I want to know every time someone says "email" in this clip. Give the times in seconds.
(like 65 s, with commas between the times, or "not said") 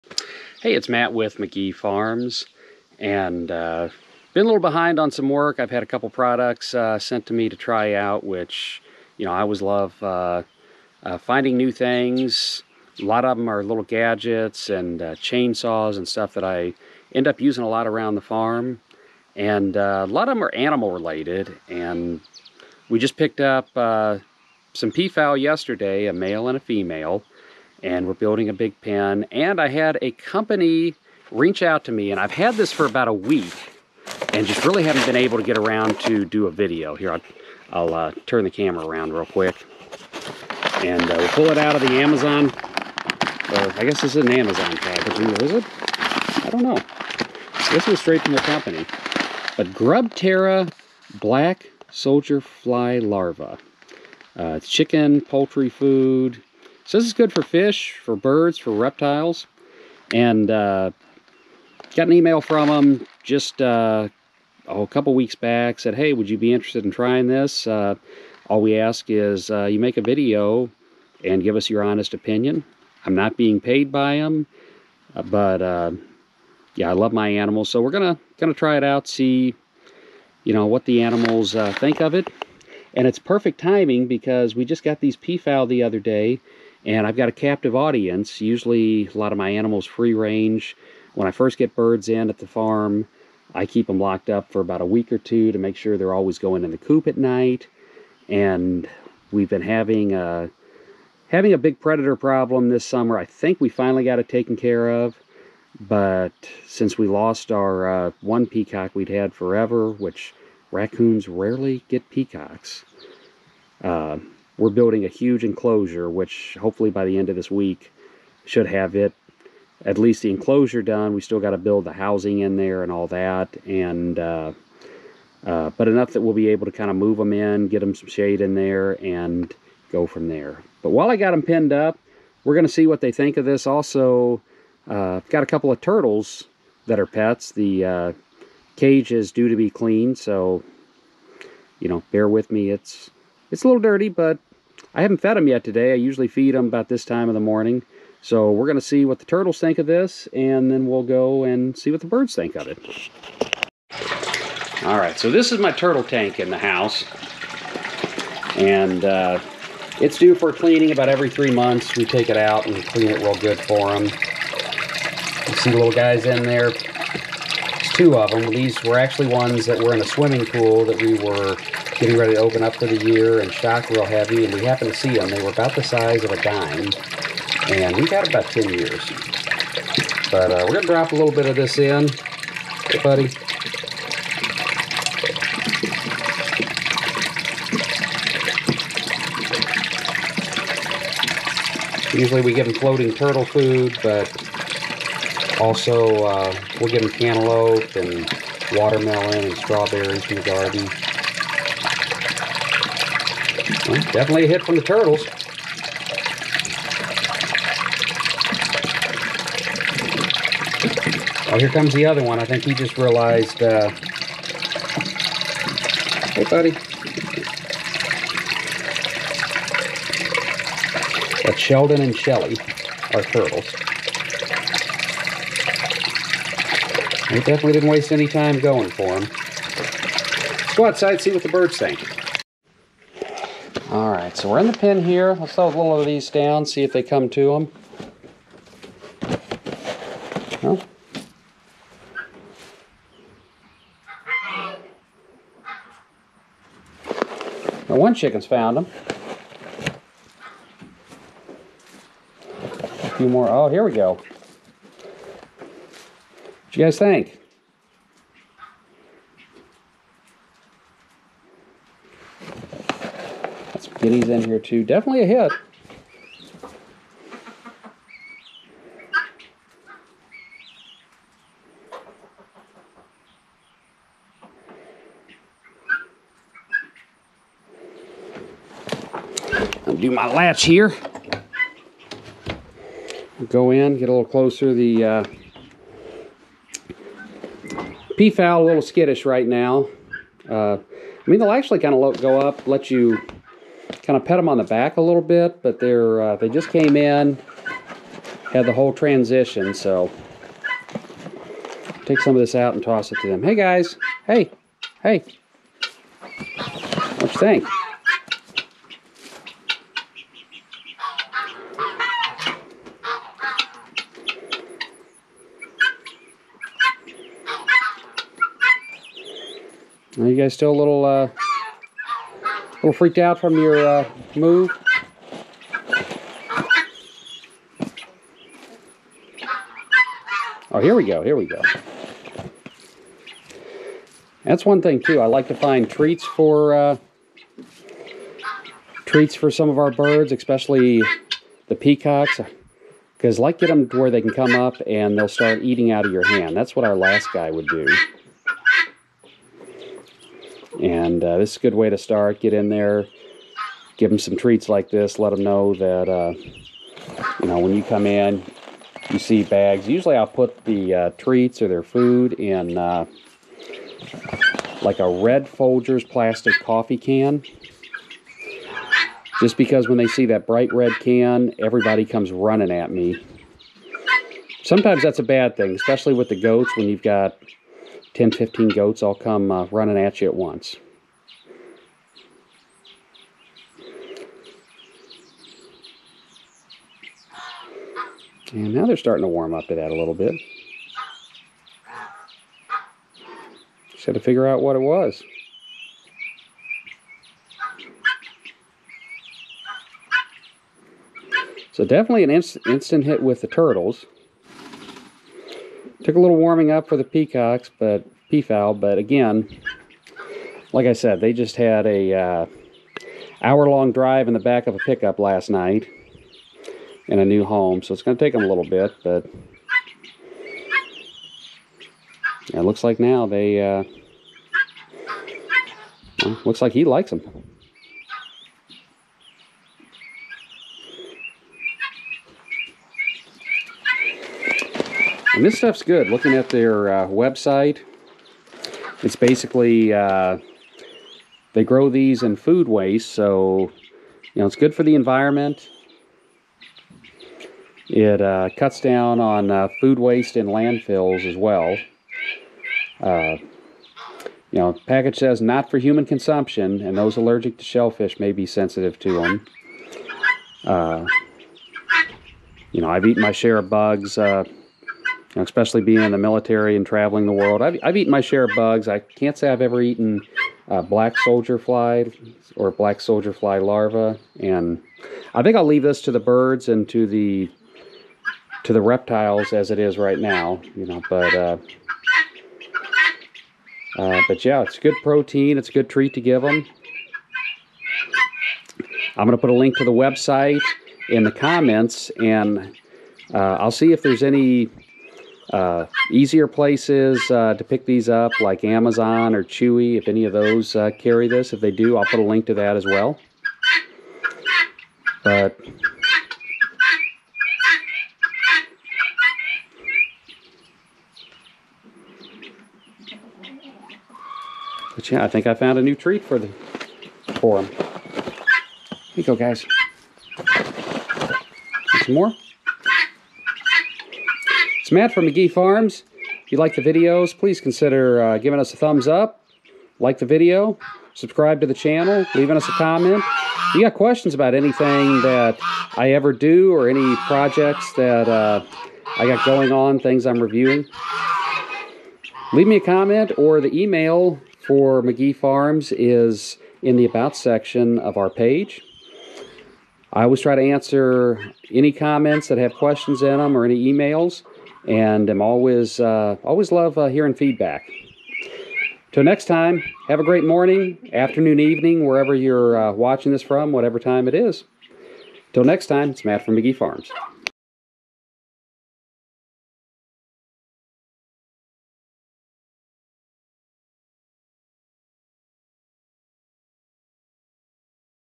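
62 s, 543 s, 553 s.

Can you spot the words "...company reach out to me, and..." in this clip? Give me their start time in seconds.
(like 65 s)
30 s.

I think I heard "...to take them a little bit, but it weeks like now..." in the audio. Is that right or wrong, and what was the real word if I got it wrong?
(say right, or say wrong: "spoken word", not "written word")
wrong: "looks", not "weeks".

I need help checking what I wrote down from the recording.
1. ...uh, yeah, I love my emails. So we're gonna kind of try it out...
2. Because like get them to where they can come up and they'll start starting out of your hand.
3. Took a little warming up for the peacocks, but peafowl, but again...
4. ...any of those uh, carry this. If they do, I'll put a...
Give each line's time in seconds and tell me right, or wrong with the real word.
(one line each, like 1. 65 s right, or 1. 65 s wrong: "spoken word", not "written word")
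1. 75 s wrong: "animals", not "emails"
2. 343 s wrong: "eating", not "starting"
3. 406 s right
4. 500 s right.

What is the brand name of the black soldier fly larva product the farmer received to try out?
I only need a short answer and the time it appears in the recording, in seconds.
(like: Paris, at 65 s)
Grubterra, at 49 s.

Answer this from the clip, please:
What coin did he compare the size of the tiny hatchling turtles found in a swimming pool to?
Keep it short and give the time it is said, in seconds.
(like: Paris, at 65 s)
A dime, at 175 s.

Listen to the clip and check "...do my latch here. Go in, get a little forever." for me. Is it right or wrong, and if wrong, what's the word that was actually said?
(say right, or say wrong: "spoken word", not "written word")
wrong: "closer", not "forever".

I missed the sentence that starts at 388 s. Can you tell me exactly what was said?
And now they're starting to warm up to that a little bit.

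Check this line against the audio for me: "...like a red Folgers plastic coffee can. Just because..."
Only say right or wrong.
right.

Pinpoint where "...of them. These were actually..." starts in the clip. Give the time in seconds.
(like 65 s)
168 s.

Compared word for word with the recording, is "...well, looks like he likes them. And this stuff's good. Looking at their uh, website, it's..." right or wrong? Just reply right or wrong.
right.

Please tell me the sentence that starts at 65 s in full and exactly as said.
Said, hey, would you be interested in trying this?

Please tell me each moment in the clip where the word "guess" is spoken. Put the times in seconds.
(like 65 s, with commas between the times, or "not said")
43 s.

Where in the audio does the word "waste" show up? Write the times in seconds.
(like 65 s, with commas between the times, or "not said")
227 s, 442 s, 449 s.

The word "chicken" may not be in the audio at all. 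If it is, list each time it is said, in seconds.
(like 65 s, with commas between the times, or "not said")
54 s, 248 s.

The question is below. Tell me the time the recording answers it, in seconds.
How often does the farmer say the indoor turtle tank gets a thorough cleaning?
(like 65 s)
161 s.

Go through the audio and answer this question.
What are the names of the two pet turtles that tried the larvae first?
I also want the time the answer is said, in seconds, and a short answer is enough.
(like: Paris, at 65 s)
Sheldon and Shelly, at 221 s.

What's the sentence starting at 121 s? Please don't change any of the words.
We still got to build the housing in there and all that.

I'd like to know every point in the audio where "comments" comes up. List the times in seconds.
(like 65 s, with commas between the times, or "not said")
491 s, 532 s, 542 s, 551 s.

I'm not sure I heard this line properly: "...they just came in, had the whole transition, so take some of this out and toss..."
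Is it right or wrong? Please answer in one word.
right.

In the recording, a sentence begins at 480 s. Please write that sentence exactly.
You know, but uh, uh, but yeah, it's good protein.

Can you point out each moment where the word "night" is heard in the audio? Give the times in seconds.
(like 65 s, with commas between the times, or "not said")
97 s, 415 s.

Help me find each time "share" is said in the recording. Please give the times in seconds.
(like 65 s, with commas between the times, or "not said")
463 s, 468 s.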